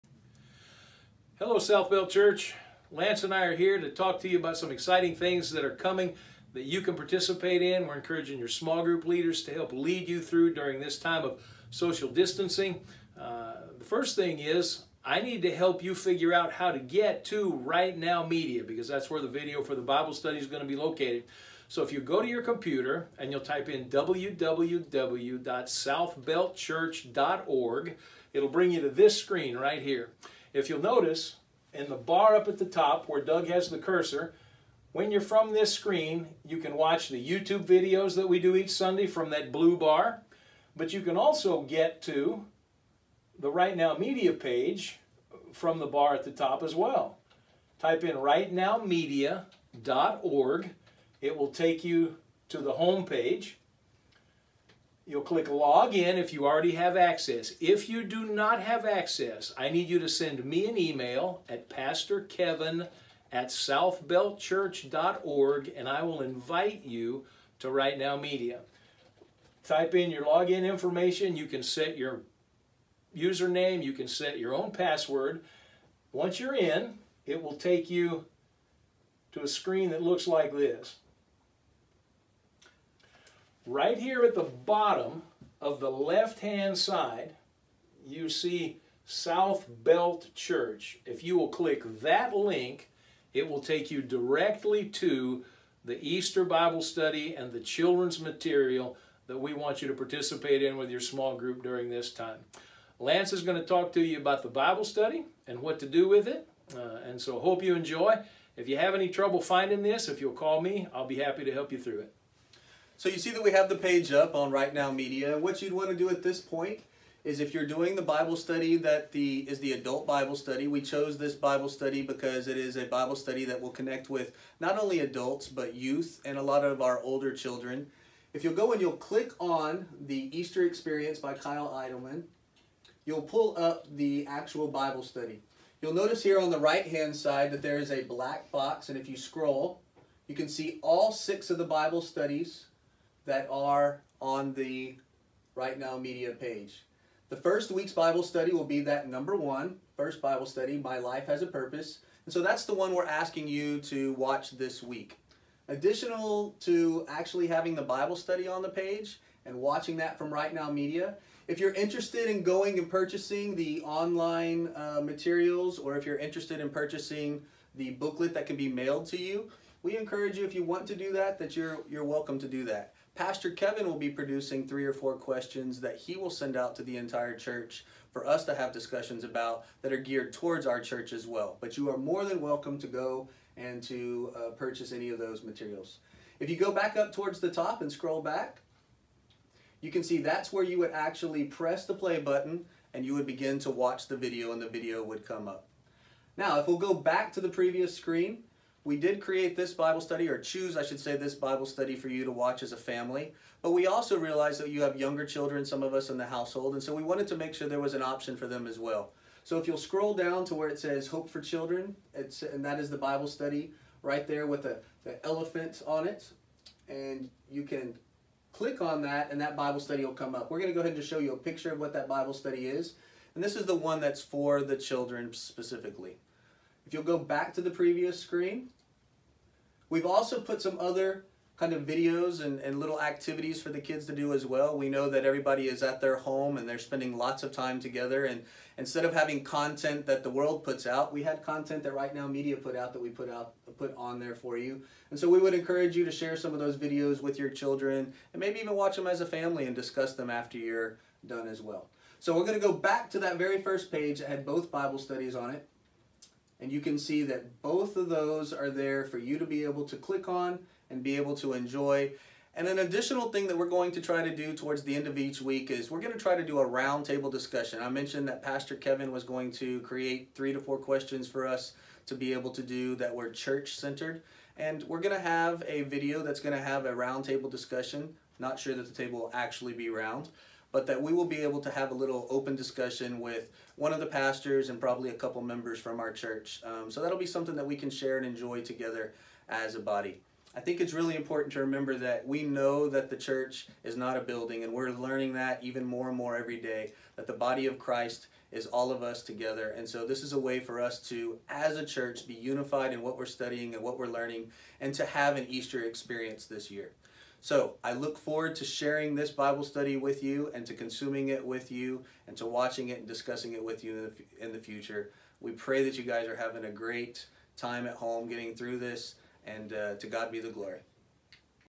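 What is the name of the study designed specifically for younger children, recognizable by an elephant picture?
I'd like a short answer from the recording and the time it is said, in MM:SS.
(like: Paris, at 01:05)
Hope for Children, at 03:31.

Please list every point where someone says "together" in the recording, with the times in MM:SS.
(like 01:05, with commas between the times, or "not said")
03:57, 04:48, 04:59.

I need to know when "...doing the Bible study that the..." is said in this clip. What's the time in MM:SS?
01:57.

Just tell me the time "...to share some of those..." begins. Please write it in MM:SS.
04:06.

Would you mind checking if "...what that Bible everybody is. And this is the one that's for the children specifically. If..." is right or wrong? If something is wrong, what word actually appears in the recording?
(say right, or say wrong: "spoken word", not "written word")
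wrong: "study", not "everybody".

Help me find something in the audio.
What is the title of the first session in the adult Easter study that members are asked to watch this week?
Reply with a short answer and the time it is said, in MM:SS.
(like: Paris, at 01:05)
My Life Has a Purpose, at 02:30.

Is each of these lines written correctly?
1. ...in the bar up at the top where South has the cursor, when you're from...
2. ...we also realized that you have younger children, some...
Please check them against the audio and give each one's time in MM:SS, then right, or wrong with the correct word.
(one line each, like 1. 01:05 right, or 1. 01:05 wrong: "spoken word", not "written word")
1. 00:31 wrong: "Doug", not "South"
2. 03:23 right.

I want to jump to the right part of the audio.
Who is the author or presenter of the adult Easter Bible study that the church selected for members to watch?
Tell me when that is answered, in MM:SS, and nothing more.
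02:11.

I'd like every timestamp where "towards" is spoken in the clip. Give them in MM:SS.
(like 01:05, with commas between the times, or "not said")
03:00, 03:07, 04:24.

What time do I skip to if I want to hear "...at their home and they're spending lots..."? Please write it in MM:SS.
03:55.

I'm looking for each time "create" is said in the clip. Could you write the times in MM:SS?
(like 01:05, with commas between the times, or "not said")
03:19, 04:29.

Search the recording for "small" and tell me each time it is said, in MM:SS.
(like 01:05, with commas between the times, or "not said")
00:08, 01:40.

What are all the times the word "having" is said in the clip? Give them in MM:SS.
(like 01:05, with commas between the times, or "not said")
02:37, 03:59, 05:16.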